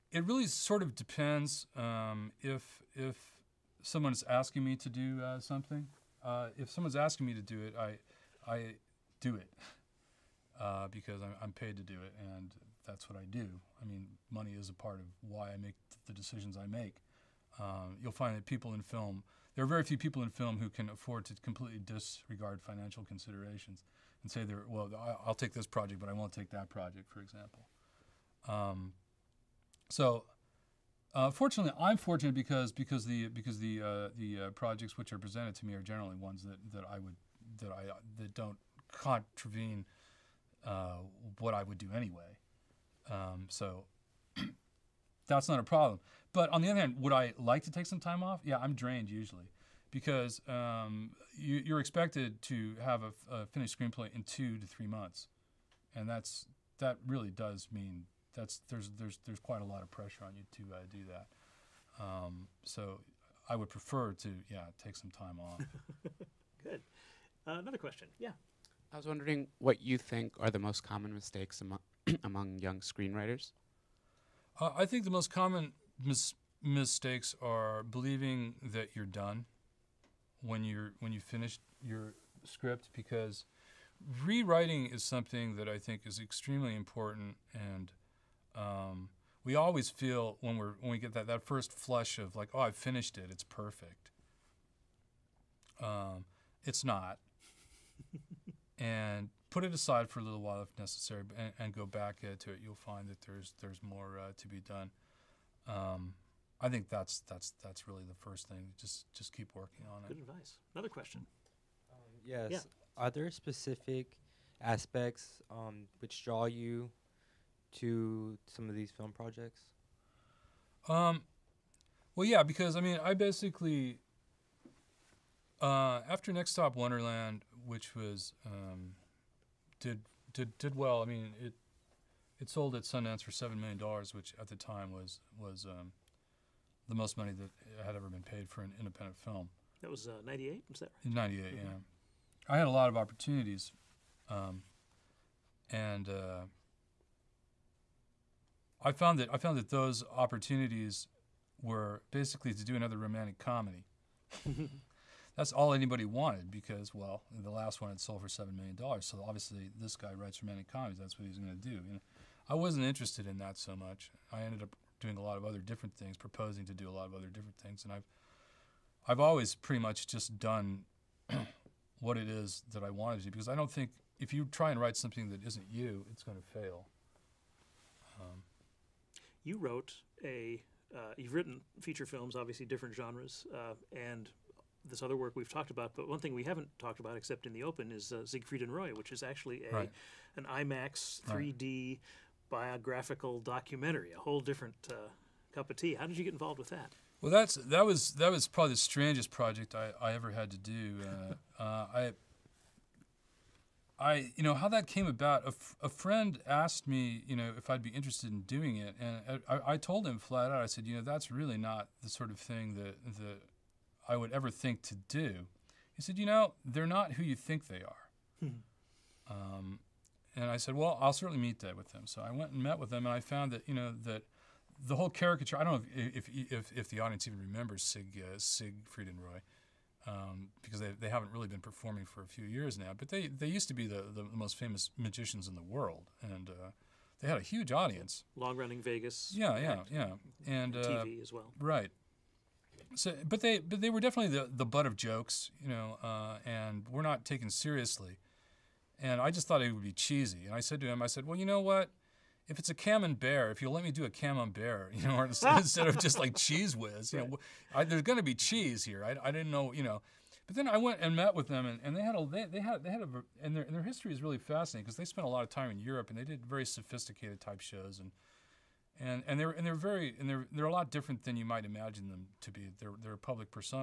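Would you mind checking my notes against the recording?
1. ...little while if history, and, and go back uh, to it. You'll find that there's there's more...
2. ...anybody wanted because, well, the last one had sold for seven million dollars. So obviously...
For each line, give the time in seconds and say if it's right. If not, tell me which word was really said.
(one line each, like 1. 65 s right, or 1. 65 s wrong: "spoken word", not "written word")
1. 100 s wrong: "necessary", not "history"
2. 155 s right.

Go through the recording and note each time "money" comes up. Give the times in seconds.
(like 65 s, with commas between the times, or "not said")
14 s, 137 s.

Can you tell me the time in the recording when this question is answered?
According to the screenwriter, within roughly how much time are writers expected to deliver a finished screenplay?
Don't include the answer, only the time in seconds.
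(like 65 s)
54 s.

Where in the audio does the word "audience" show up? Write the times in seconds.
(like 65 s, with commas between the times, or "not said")
227 s, 237 s.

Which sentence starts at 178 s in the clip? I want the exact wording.
Um, you wrote a uh, you've written feature films, obviously different genres, uh, and this other work we've talked about.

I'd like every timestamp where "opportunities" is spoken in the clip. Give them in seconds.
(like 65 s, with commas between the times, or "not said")
142 s, 150 s.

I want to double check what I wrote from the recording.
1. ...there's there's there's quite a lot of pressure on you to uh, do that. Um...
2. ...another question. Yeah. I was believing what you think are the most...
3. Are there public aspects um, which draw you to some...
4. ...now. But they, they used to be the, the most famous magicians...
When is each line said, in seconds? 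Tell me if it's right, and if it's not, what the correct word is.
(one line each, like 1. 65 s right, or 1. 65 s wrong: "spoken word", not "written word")
1. 58 s right
2. 67 s wrong: "wondering", not "believing"
3. 112 s wrong: "specific", not "public"
4. 232 s right.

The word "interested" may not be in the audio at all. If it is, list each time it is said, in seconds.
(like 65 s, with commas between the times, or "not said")
162 s, 207 s.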